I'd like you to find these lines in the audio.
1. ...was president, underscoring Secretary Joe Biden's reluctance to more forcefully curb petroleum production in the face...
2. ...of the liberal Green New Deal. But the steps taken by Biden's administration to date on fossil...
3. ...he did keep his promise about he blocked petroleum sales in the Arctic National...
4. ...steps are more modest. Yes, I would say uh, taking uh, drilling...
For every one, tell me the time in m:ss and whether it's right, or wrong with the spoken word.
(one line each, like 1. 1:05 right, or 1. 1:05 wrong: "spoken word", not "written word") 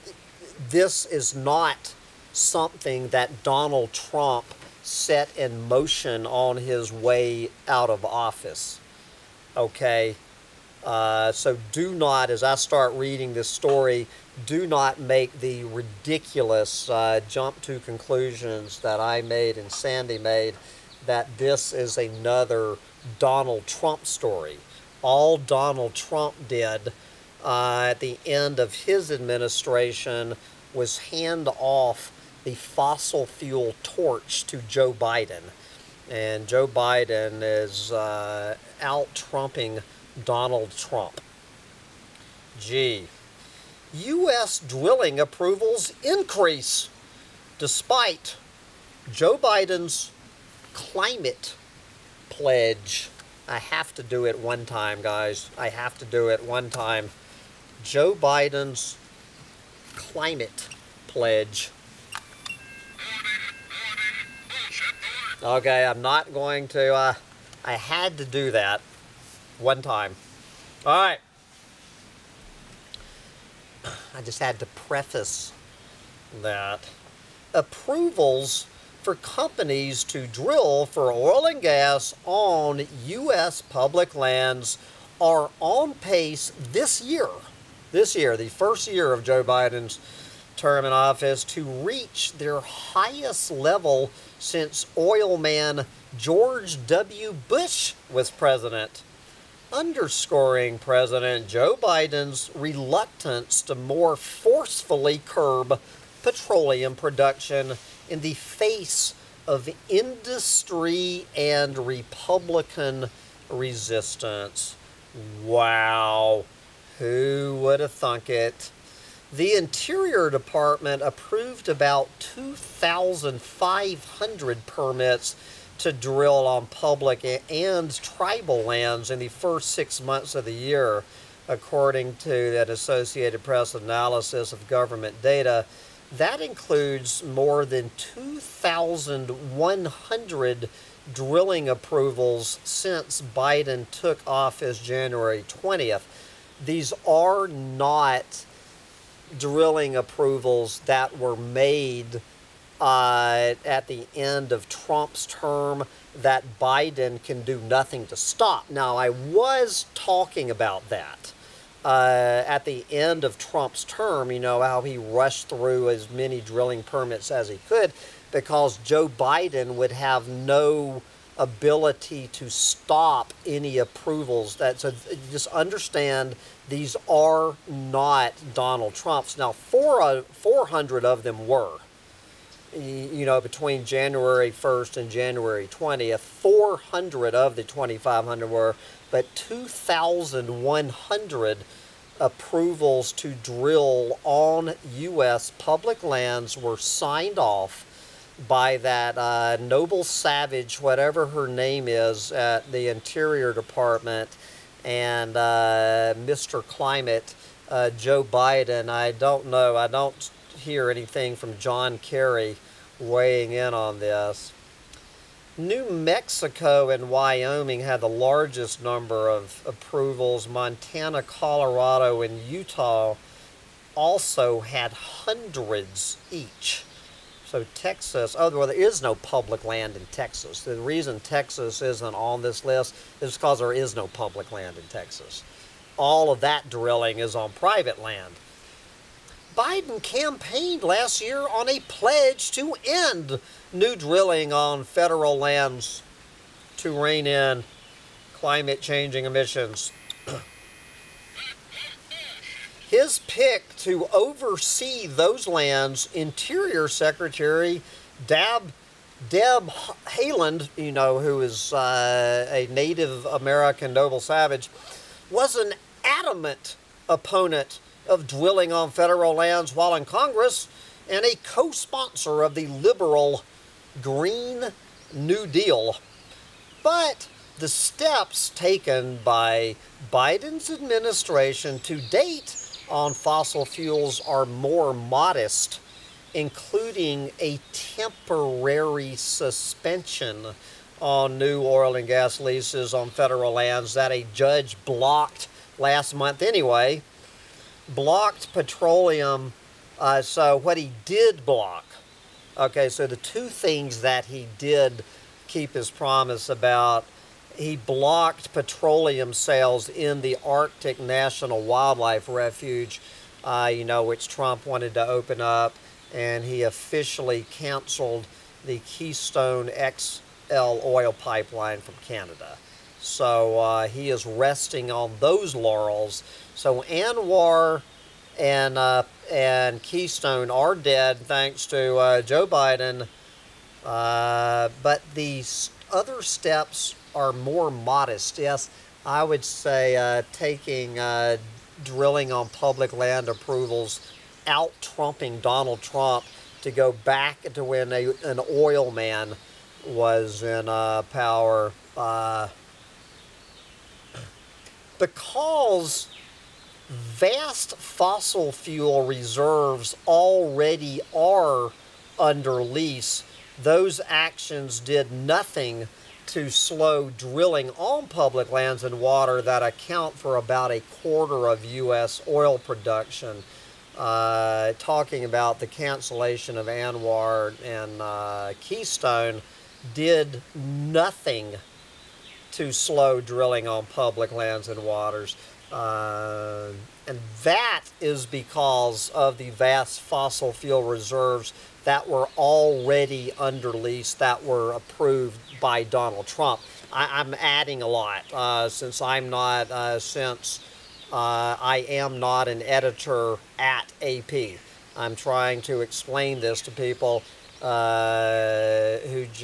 1. 1:38 wrong: "President", not "Secretary"
2. 4:32 right
3. 5:04 right
4. 5:36 right.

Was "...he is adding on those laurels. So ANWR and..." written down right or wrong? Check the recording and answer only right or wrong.
wrong.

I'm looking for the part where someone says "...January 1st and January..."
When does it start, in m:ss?
3:03.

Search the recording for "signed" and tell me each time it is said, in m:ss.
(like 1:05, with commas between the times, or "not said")
3:16.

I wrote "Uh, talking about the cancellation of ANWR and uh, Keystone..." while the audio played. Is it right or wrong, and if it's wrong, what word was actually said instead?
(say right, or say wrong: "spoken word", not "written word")
right.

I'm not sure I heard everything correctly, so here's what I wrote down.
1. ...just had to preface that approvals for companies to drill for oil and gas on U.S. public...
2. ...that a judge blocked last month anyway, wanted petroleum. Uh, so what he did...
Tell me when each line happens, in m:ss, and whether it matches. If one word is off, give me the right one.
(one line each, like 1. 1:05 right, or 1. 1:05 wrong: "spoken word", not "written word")
1. 1:14 right
2. 4:53 wrong: "blocked", not "wanted".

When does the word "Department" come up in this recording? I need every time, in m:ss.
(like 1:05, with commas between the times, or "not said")
2:00, 3:23.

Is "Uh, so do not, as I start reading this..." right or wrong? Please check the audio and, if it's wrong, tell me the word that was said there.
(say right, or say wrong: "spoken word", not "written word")
right.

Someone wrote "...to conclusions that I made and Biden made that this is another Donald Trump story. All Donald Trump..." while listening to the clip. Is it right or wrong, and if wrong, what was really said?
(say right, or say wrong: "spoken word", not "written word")
wrong: "Sandy", not "Biden".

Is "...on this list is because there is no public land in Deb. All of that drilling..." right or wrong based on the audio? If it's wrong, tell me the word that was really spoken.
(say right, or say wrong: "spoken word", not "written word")
wrong: "Texas", not "Deb".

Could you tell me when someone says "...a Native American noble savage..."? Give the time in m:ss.
4:22.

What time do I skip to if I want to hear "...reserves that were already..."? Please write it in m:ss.
6:30.